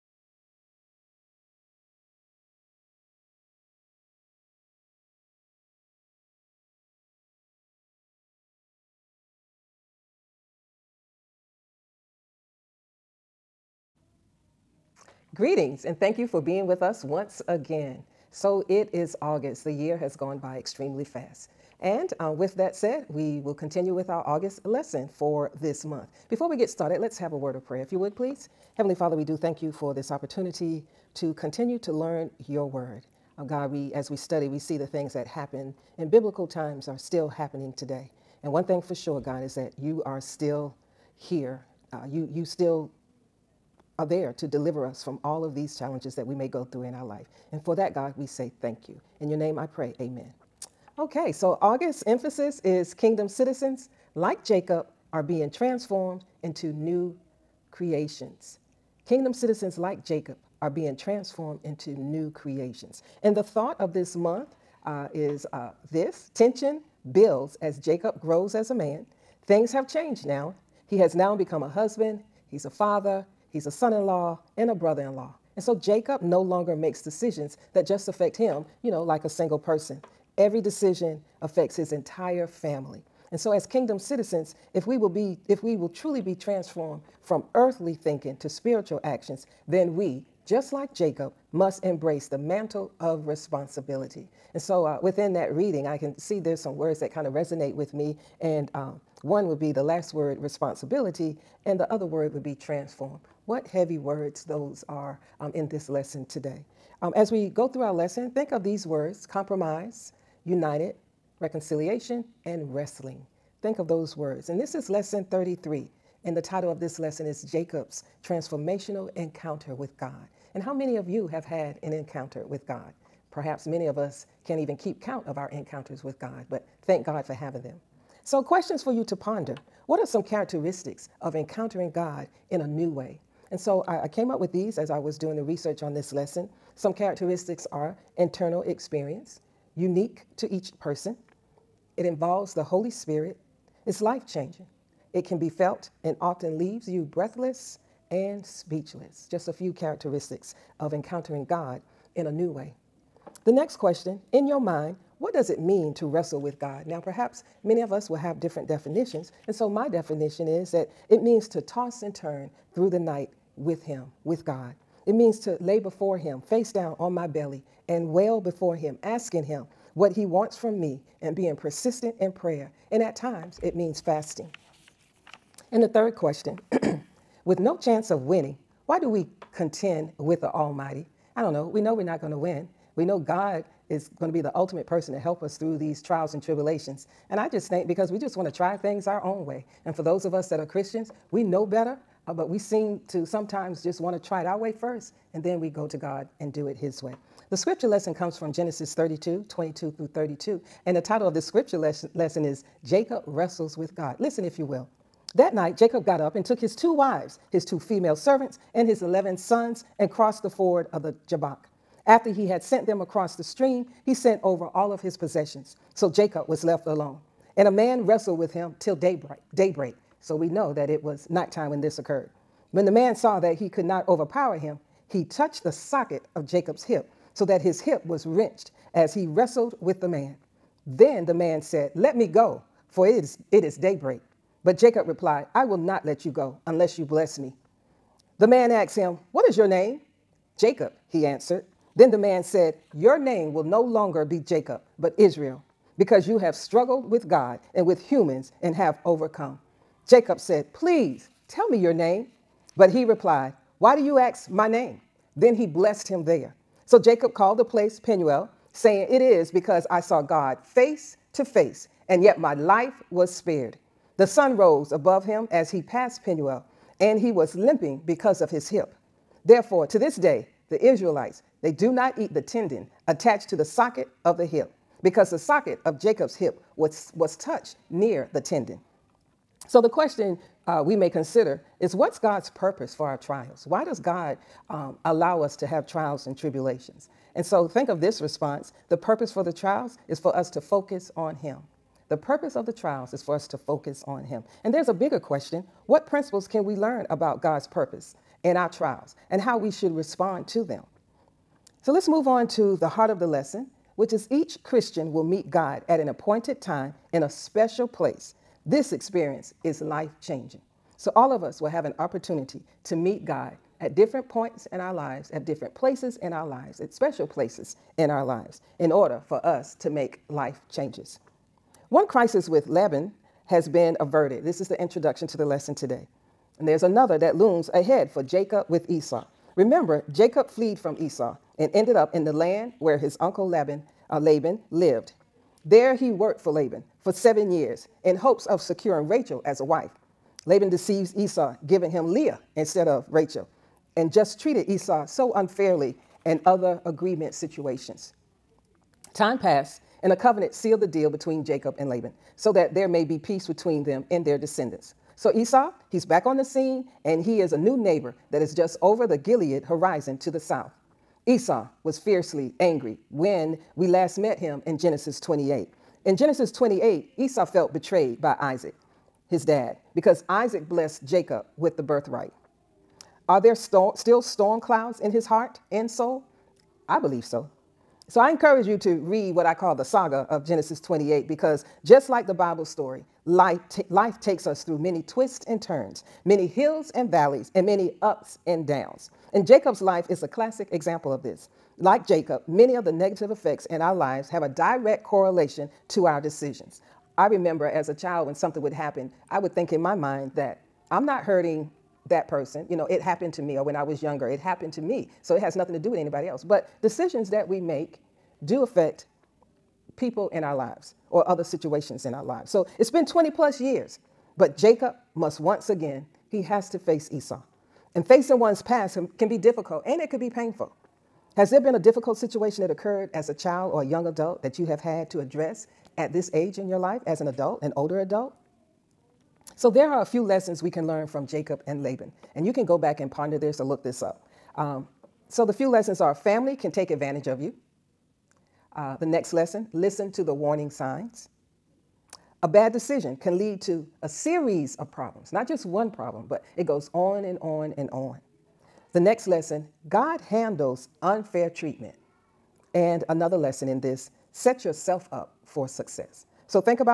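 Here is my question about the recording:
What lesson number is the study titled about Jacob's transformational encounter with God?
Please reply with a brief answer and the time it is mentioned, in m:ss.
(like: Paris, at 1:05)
33, at 1:54.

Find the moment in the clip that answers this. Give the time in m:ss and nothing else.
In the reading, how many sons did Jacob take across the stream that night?
3:29.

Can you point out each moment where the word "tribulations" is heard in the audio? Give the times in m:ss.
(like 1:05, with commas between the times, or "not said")
3:06, 4:46.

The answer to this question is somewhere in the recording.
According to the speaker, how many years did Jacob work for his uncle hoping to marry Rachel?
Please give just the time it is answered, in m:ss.
5:37.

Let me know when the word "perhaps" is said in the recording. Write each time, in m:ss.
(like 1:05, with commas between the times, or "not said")
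2:03, 2:36.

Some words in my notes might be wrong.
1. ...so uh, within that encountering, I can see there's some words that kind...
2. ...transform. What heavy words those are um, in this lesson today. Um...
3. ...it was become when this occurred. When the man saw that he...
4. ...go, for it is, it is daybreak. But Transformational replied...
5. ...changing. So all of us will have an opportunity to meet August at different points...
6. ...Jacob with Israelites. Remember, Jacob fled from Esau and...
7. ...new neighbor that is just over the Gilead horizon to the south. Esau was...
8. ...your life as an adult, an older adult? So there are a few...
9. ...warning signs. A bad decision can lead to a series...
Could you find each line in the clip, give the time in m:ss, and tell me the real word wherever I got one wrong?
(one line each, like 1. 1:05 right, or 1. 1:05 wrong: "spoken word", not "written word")
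1. 1:34 wrong: "reading", not "encountering"
2. 1:42 right
3. 3:40 wrong: "nighttime", not "become"
4. 3:52 wrong: "Jacob", not "Transformational"
5. 5:10 wrong: "God", not "August"
6. 5:28 wrong: "Esau", not "Israelites"
7. 5:57 right
8. 7:06 right
9. 7:20 right.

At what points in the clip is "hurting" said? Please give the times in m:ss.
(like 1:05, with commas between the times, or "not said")
6:41.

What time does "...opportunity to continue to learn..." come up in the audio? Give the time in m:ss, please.
0:30.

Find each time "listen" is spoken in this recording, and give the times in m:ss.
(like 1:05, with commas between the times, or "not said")
3:24, 7:19.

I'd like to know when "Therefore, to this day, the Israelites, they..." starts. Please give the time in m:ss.
4:29.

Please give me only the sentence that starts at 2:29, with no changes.
Just a few characteristics of encountering God in a new way.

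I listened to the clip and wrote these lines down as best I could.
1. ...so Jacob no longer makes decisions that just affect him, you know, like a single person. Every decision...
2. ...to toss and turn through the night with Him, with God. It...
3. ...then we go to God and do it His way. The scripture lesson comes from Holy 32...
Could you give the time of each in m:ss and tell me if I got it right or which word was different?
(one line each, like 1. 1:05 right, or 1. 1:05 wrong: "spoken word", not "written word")
1. 1:15 right
2. 2:41 right
3. 3:15 wrong: "Genesis", not "Holy".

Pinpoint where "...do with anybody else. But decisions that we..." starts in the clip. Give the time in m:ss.
6:45.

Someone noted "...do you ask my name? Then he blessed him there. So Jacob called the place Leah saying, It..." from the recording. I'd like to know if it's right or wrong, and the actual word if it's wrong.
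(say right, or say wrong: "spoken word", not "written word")
wrong: "Peniel", not "Leah".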